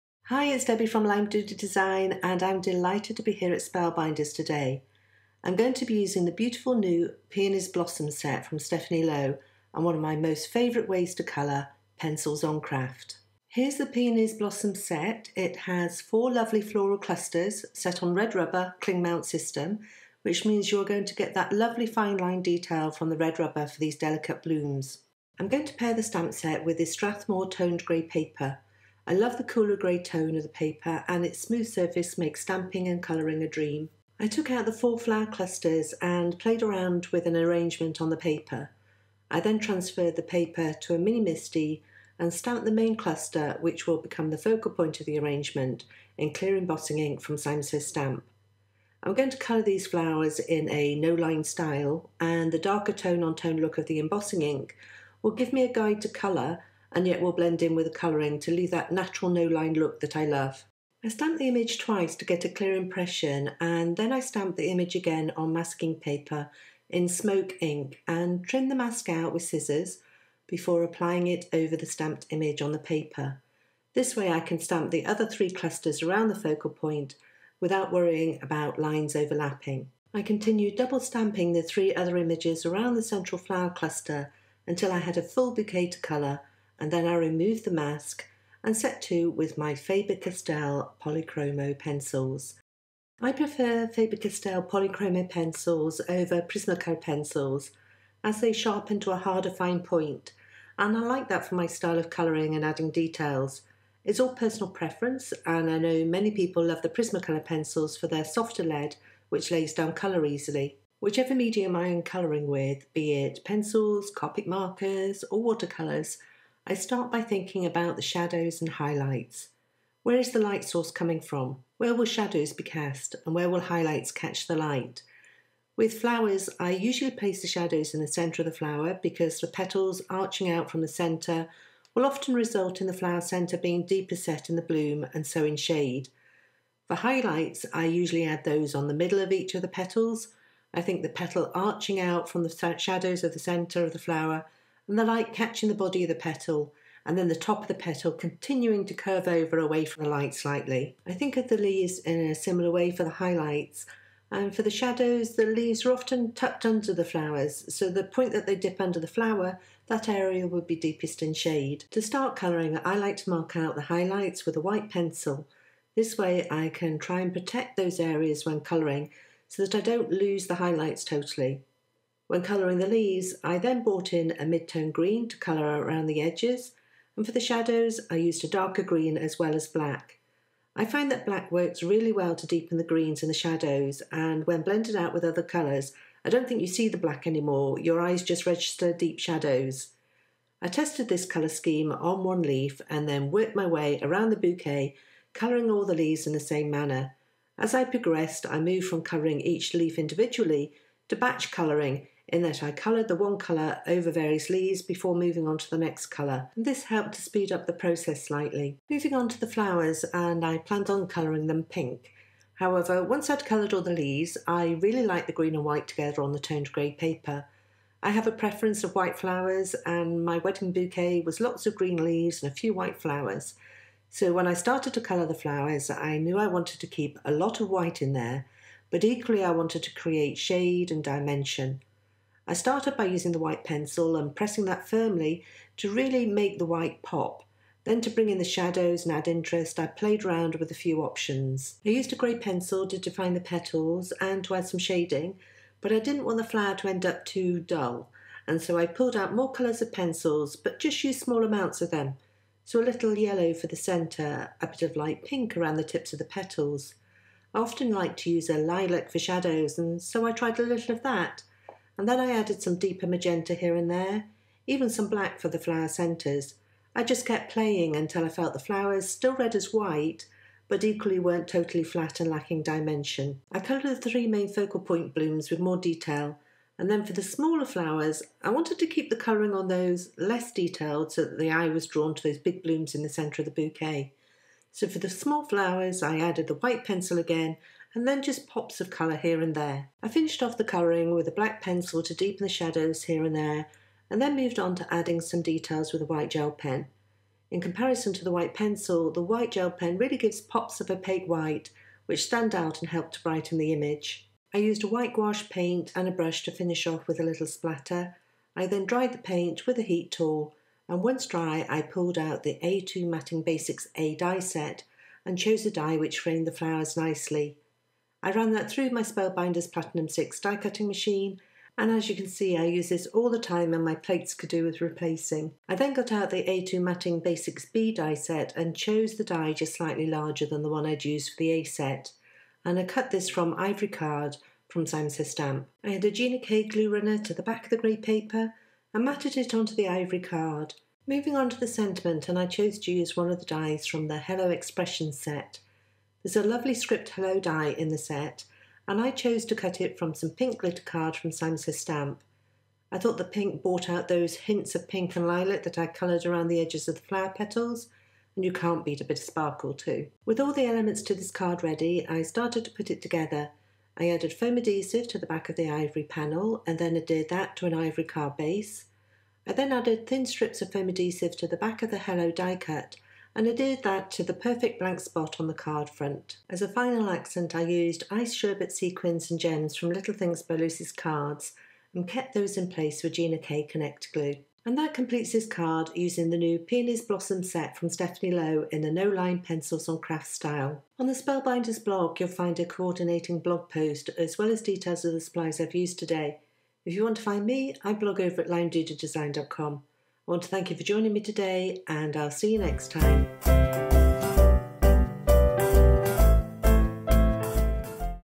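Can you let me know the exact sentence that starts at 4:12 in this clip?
So a little yellow for the centre, a bit of light pink around the tips of the petals.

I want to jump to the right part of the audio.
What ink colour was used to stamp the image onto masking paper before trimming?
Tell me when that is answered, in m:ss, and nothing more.
1:07.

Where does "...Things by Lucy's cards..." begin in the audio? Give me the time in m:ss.
6:20.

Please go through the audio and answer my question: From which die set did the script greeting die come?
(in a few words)
Hello Expression.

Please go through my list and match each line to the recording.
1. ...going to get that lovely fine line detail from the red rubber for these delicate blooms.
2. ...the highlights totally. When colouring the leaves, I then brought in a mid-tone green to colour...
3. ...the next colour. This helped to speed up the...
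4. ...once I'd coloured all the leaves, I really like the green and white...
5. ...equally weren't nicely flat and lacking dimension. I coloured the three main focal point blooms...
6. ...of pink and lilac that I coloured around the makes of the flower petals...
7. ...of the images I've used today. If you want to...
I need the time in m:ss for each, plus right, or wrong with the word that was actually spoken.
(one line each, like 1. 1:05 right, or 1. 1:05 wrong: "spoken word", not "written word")
1. 0:20 right
2. 2:50 right
3. 3:25 right
4. 3:33 right
5. 4:30 wrong: "totally", not "nicely"
6. 5:54 wrong: "edges", not "makes"
7. 6:35 wrong: "supplies", not "images".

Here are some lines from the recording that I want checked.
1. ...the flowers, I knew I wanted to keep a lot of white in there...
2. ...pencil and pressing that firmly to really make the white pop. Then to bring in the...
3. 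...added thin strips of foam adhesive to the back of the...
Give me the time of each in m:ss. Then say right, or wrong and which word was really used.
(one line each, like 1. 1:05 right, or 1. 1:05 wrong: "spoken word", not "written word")
1. 3:45 right
2. 3:53 right
3. 6:09 right.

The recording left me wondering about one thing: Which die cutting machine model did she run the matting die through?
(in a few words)
Spellbinders Platinum 6.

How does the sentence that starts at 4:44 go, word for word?
So for the small flowers, I added the white pencil again and then just pops of colour here and there.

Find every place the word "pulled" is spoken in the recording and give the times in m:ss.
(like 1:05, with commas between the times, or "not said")
4:08, 5:11.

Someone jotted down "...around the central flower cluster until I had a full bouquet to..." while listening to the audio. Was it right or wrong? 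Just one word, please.
right.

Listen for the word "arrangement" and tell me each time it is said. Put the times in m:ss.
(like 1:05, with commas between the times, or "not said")
0:37, 0:45.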